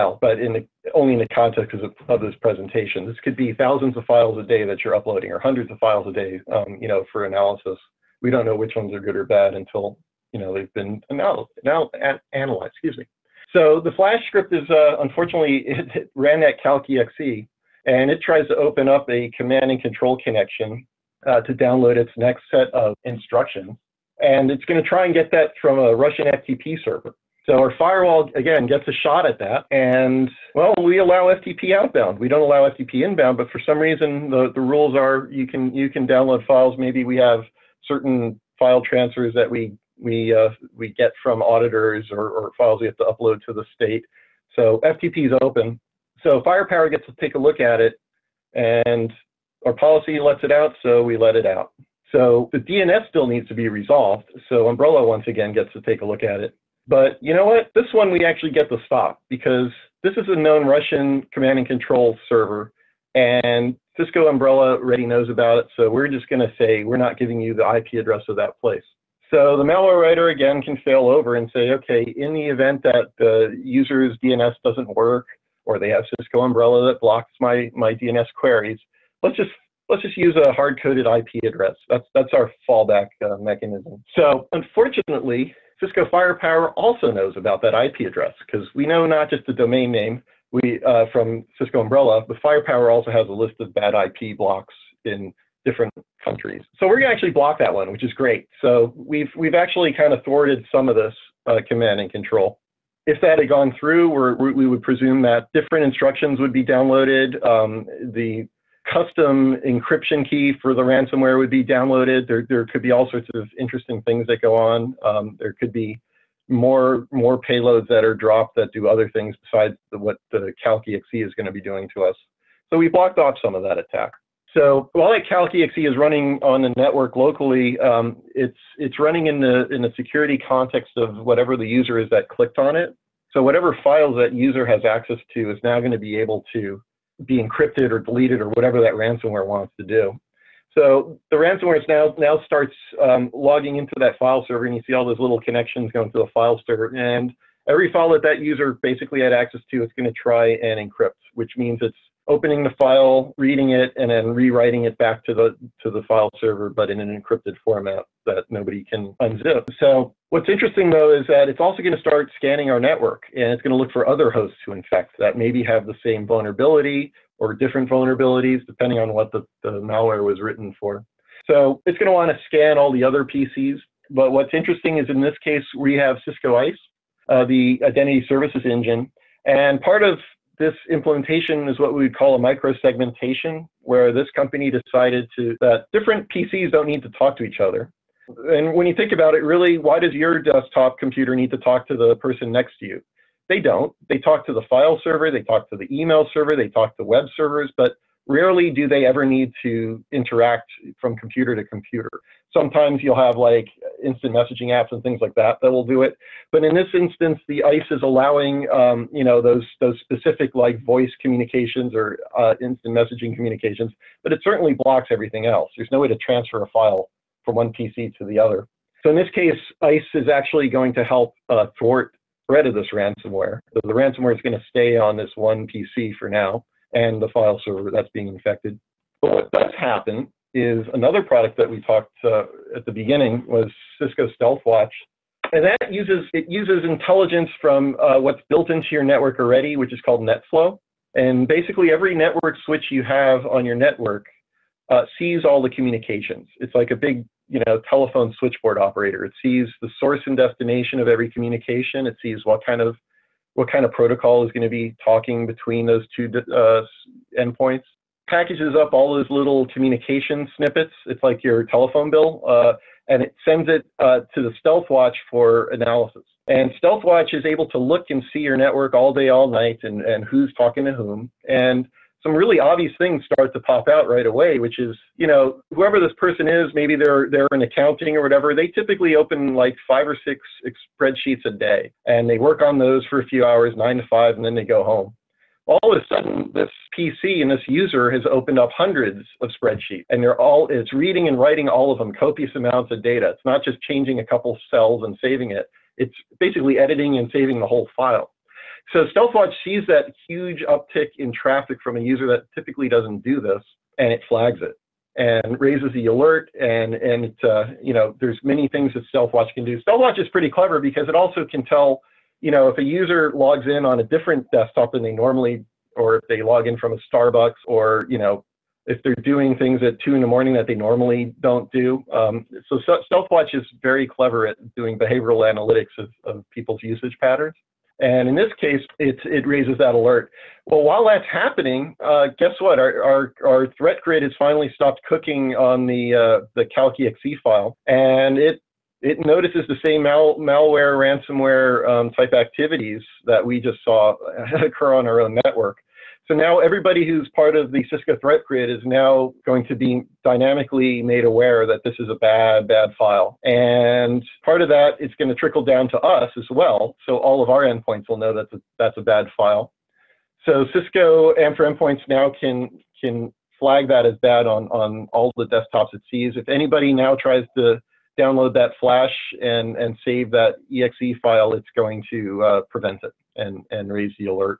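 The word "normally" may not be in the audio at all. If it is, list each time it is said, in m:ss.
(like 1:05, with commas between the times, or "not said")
5:15, 5:20.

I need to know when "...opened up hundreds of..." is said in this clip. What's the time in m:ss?
4:48.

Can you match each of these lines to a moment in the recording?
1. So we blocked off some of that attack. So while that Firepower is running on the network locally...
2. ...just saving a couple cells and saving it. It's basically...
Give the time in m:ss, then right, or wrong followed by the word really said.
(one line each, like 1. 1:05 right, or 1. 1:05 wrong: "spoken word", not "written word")
1. 2:02 wrong: "CalcEXE", not "Firepower"
2. 4:53 wrong: "changing", not "saving".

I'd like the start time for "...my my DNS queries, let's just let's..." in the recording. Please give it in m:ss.
1:17.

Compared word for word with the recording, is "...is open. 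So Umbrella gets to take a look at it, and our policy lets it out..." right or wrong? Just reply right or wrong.
wrong.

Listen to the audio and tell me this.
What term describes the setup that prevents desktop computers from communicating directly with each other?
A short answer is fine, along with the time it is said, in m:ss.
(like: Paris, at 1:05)
microsegmentation, at 3:02.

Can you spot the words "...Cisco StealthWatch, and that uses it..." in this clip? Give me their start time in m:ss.
3:54.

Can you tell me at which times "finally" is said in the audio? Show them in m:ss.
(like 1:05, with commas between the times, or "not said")
5:34.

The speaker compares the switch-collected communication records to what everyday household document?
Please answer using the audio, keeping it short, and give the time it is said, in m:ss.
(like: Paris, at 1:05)
telephone bill, at 4:21.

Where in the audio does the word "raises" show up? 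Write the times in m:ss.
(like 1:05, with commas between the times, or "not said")
5:05, 5:29, 6:13.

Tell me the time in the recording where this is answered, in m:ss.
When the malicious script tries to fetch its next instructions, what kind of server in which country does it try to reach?
0:25.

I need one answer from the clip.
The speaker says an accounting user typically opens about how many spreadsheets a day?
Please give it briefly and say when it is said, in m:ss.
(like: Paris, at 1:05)
5 or 6, at 4:39.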